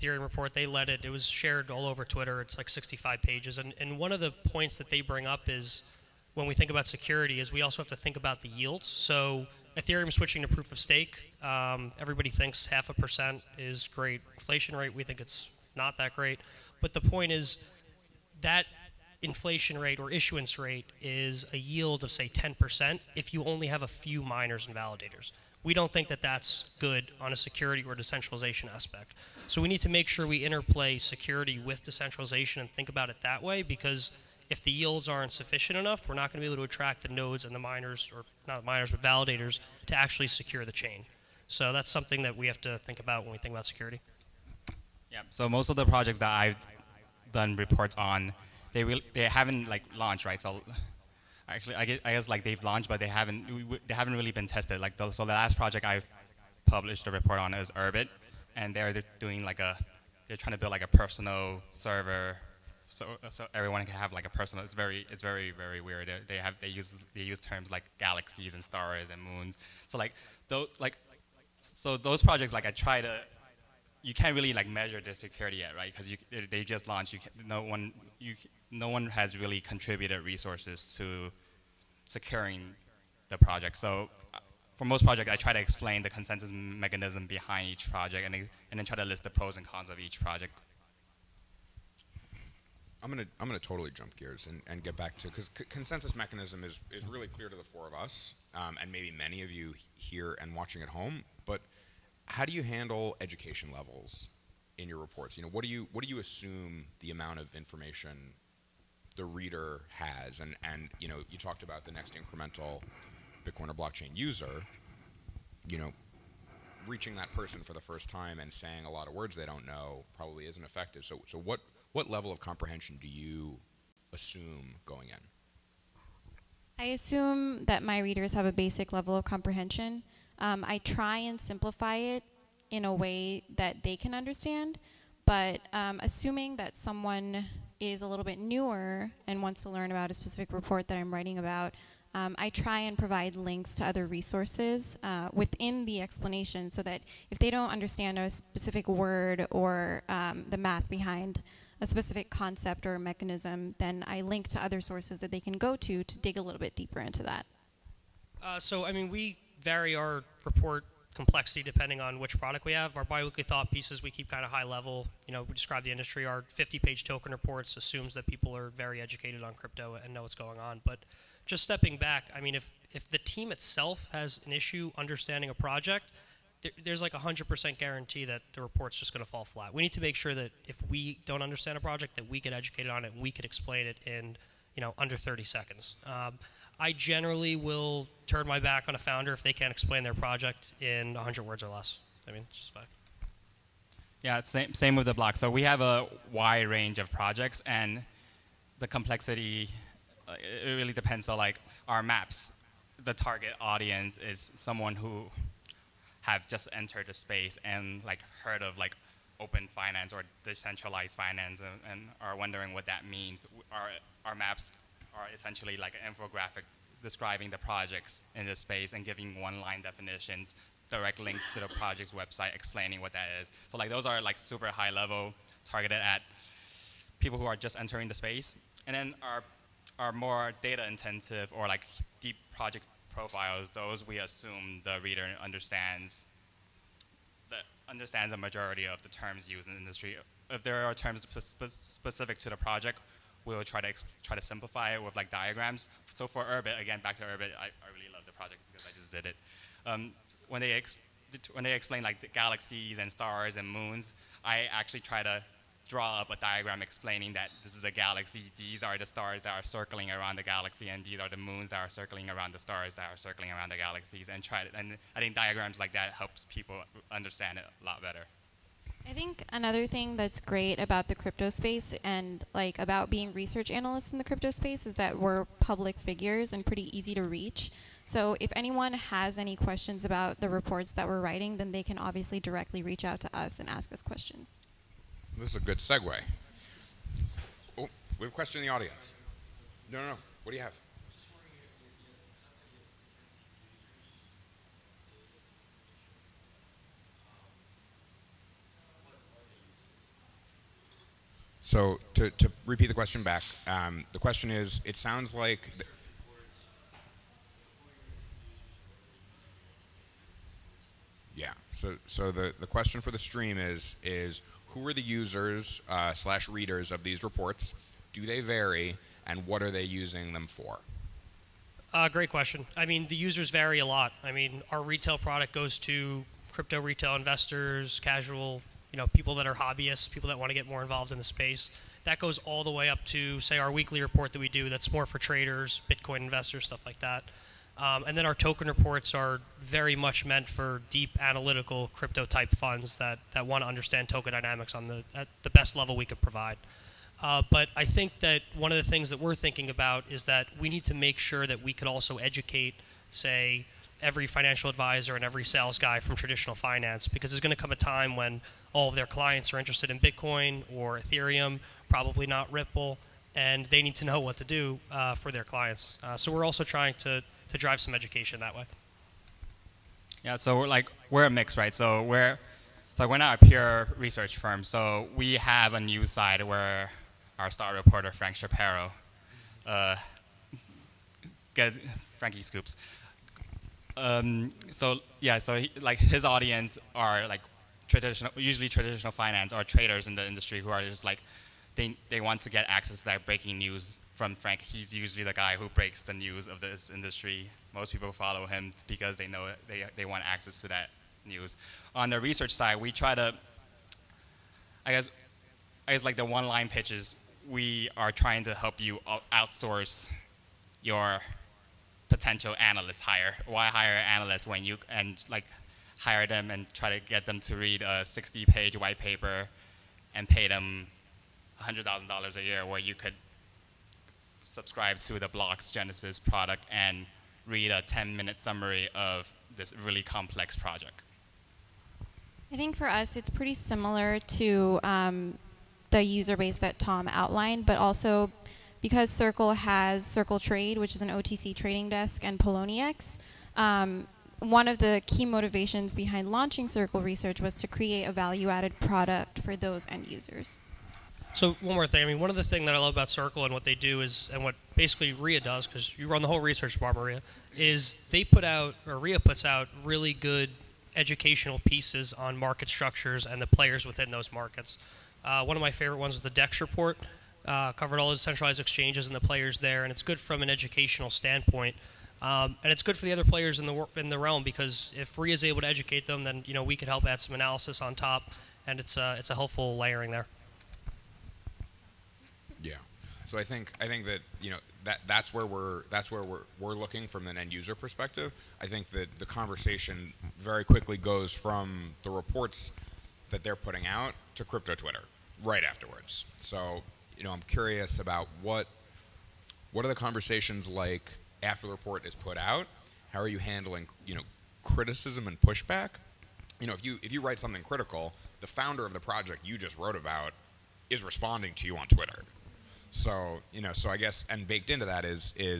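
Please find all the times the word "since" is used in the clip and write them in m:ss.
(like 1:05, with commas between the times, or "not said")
not said.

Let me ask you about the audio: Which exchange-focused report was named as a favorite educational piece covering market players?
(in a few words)
The DEX report.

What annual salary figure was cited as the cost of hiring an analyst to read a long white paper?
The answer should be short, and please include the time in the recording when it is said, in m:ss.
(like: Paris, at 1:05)
$100,000, at 7:01.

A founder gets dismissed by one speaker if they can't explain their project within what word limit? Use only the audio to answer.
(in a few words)
100 words.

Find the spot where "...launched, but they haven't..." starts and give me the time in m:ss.
0:52.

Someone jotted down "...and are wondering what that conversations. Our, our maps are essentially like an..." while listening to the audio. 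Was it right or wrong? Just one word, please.
wrong.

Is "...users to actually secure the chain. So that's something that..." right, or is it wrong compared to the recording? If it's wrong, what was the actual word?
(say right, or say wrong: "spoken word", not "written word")
wrong: "validators", not "users".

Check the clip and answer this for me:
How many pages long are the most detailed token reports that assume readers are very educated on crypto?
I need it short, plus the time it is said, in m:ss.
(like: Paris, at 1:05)
50, at 2:46.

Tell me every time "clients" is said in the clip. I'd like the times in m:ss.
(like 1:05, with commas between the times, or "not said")
5:59, 6:05.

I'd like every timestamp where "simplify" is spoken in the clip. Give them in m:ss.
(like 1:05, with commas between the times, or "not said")
2:11, 4:04.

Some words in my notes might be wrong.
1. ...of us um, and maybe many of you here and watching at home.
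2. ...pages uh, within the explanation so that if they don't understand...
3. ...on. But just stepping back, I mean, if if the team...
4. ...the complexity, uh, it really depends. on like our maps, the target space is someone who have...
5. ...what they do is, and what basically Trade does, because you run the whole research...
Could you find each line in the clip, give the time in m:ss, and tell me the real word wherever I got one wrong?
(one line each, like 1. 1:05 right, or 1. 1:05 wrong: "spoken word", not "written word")
1. 1:37 right
2. 2:24 wrong: "resources", not "pages"
3. 2:50 right
4. 3:18 wrong: "audience", not "space"
5. 7:33 wrong: "RIA", not "Trade".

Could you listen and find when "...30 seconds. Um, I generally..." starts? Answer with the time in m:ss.
3:05.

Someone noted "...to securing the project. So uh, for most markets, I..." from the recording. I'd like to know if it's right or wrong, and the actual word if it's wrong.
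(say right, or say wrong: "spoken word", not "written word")
wrong: "projects", not "markets".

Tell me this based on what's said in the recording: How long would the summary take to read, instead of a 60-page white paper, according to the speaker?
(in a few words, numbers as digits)
10 minutes.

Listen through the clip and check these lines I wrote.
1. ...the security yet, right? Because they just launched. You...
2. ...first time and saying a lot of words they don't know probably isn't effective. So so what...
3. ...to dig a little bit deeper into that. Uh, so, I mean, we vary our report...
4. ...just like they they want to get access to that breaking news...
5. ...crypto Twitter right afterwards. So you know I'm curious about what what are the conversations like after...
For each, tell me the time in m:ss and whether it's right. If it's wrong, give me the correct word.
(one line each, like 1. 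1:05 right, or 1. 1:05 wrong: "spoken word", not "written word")
1. 1:14 right
2. 1:57 right
3. 2:36 right
4. 6:30 right
5. 8:14 right.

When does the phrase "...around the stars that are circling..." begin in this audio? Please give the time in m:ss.
4:22.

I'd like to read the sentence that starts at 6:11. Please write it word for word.
So we're so we're not a pure research firm.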